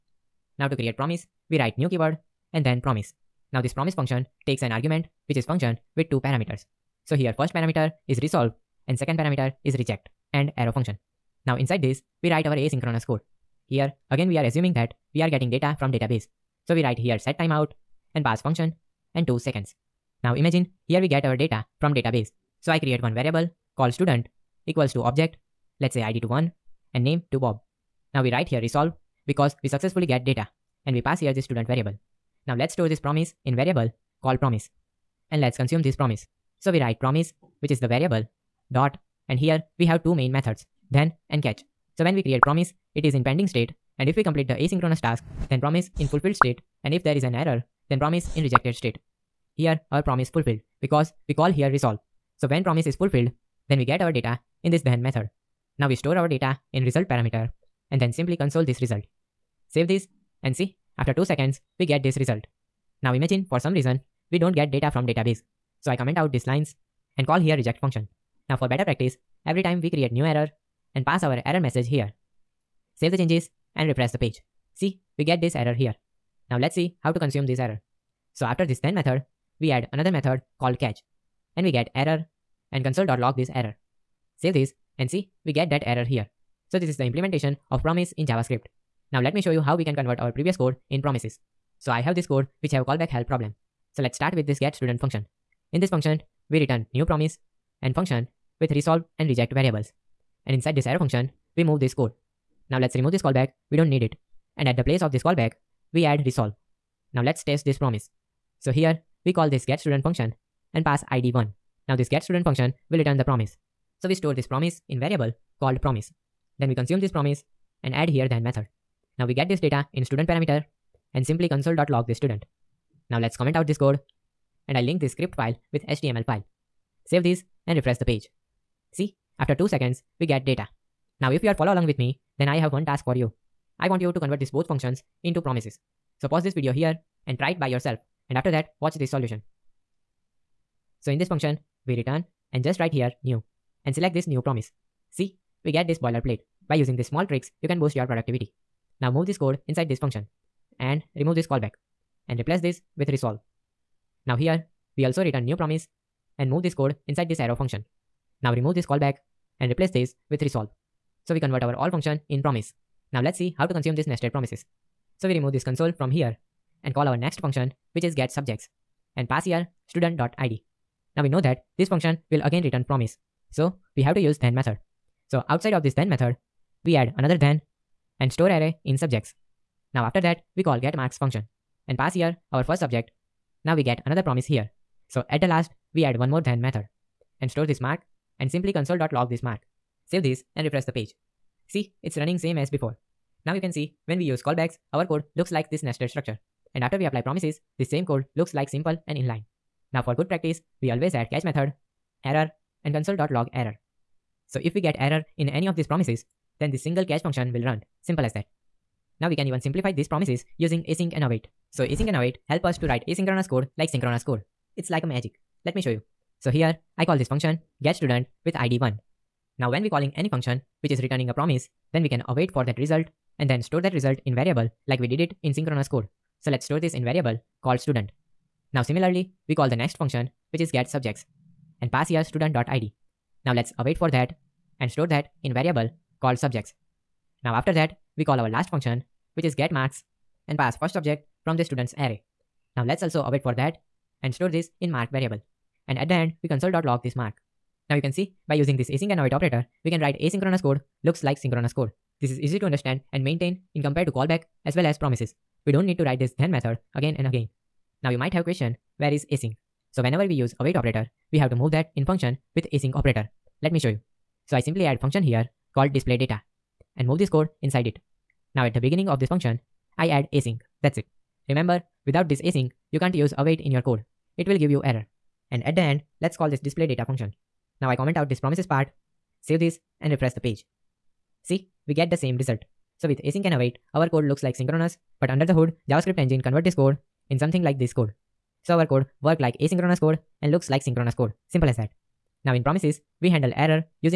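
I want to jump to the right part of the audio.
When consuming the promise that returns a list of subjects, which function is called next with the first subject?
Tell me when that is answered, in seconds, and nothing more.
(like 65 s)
180 s.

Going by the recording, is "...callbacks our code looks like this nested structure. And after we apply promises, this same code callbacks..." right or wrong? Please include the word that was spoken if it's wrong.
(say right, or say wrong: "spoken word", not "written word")
wrong: "looks", not "callbacks".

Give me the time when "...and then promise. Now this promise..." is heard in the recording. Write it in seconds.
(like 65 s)
2 s.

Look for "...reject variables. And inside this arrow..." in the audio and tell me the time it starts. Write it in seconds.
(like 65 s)
99 s.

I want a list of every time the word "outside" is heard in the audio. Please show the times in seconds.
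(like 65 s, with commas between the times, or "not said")
175 s.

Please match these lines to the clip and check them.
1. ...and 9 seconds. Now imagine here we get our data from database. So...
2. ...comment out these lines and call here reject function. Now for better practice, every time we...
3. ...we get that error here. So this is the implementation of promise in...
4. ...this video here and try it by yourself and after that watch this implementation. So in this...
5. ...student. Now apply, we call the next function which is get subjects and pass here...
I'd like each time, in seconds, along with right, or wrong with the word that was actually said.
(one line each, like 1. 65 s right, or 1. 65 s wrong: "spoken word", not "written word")
1. 19 s wrong: "2", not "9"
2. 65 s right
3. 85 s right
4. 136 s wrong: "solution", not "implementation"
5. 227 s wrong: "similarly", not "apply".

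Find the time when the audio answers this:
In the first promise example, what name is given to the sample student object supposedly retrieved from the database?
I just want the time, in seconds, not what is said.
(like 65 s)
27 s.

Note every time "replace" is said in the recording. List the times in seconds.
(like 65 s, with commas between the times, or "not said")
152 s, 159 s.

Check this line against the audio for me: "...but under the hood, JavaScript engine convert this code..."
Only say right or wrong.
right.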